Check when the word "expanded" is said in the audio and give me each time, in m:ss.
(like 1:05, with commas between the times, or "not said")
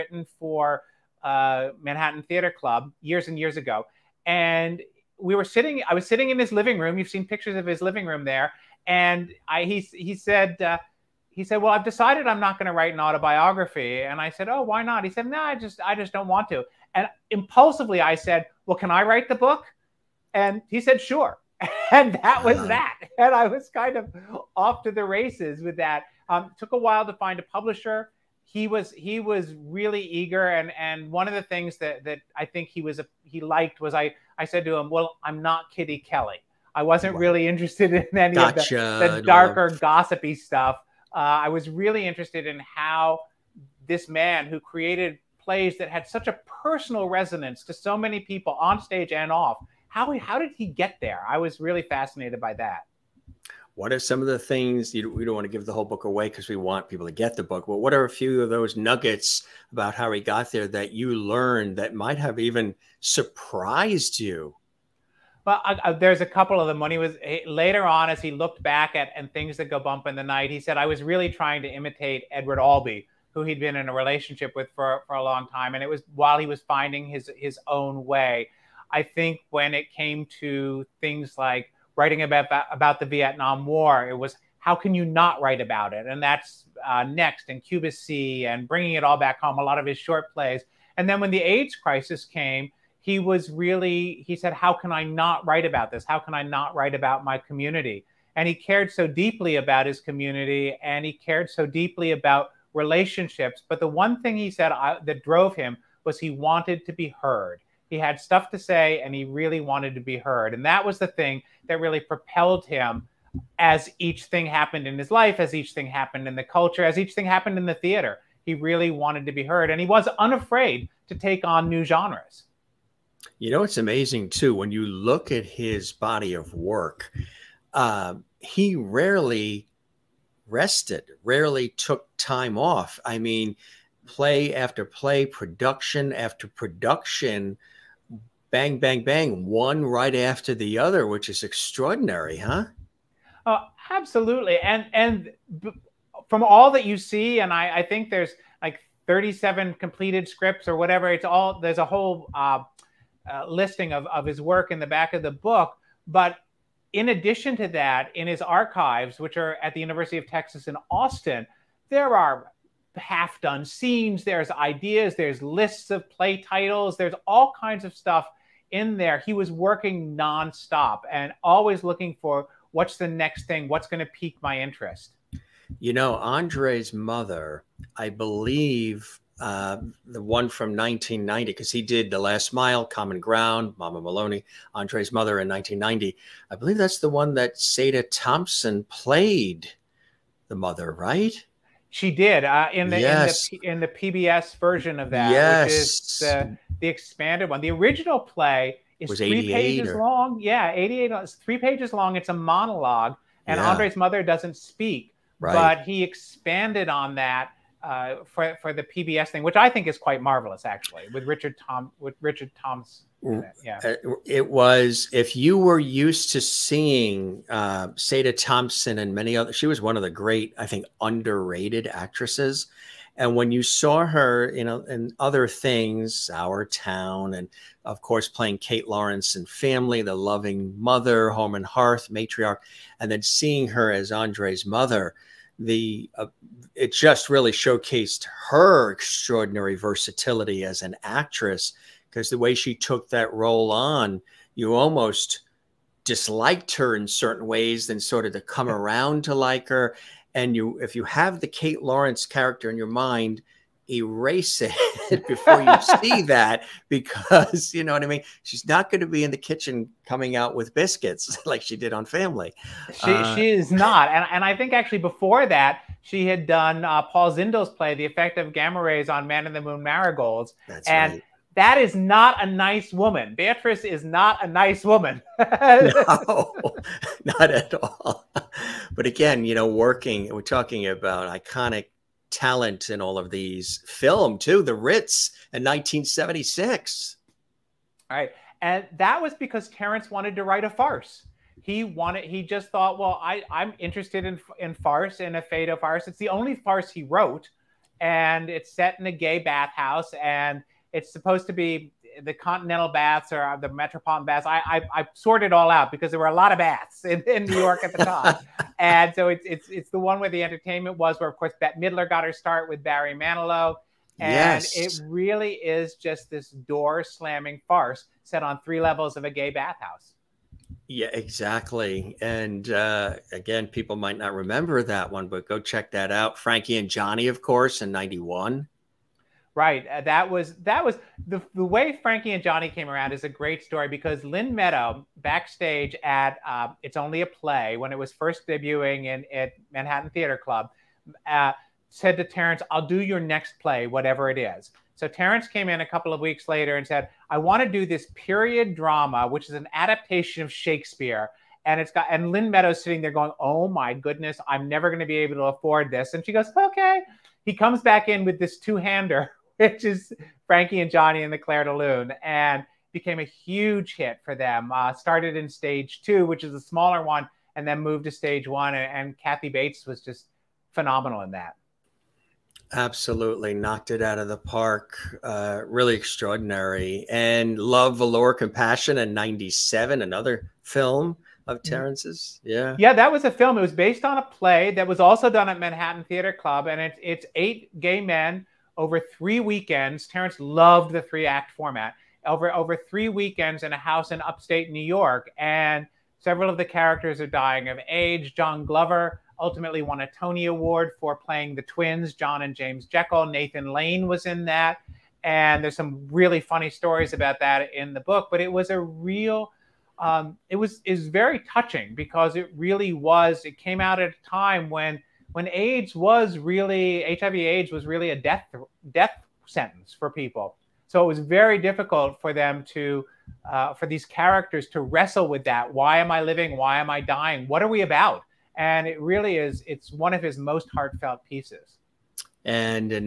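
3:16, 3:26.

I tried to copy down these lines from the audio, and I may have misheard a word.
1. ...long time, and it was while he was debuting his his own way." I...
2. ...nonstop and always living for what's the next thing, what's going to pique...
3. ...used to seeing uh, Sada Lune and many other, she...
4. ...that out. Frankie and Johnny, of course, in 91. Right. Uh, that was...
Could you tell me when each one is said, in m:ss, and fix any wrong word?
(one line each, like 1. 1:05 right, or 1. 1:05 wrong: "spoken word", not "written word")
1. 1:15 wrong: "finding", not "debuting"
2. 2:50 wrong: "looking", not "living"
3. 3:35 wrong: "Thompson", not "Lune"
4. 5:25 right.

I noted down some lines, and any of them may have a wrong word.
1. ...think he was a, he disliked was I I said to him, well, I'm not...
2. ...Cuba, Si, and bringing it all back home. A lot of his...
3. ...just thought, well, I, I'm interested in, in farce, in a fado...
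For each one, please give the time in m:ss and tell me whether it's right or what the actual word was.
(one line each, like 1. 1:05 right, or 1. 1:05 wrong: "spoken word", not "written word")
1. 0:32 wrong: "liked", not "disliked"
2. 1:27 right
3. 4:52 right.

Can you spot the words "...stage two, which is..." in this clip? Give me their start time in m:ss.
6:05.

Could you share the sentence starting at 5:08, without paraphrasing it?
and so it's, it's, it's the one where the entertainment was, where, of course, Bette Midler got her start with Barry Manilow.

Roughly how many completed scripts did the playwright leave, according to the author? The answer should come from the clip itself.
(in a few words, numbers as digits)
37.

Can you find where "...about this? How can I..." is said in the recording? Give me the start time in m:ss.
1:35.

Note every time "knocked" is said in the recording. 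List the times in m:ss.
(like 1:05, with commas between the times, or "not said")
6:13.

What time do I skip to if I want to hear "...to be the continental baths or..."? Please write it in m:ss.
5:01.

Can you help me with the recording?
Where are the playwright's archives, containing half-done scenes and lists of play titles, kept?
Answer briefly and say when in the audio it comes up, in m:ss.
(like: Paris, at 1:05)
University of Texas in Austin, at 2:39.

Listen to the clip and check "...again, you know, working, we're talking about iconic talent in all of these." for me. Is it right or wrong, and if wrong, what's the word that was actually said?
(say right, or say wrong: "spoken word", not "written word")
right.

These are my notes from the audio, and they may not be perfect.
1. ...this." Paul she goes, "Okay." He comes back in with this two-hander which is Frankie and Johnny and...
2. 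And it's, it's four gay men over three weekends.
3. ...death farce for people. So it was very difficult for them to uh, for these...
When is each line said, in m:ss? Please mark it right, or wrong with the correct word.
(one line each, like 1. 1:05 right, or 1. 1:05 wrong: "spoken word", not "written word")
1. 5:55 wrong: "And", not "Paul"
2. 6:26 wrong: "eight", not "four"
3. 6:58 wrong: "sentence", not "farce".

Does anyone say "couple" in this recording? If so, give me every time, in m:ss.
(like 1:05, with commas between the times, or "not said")
1:06, 5:45.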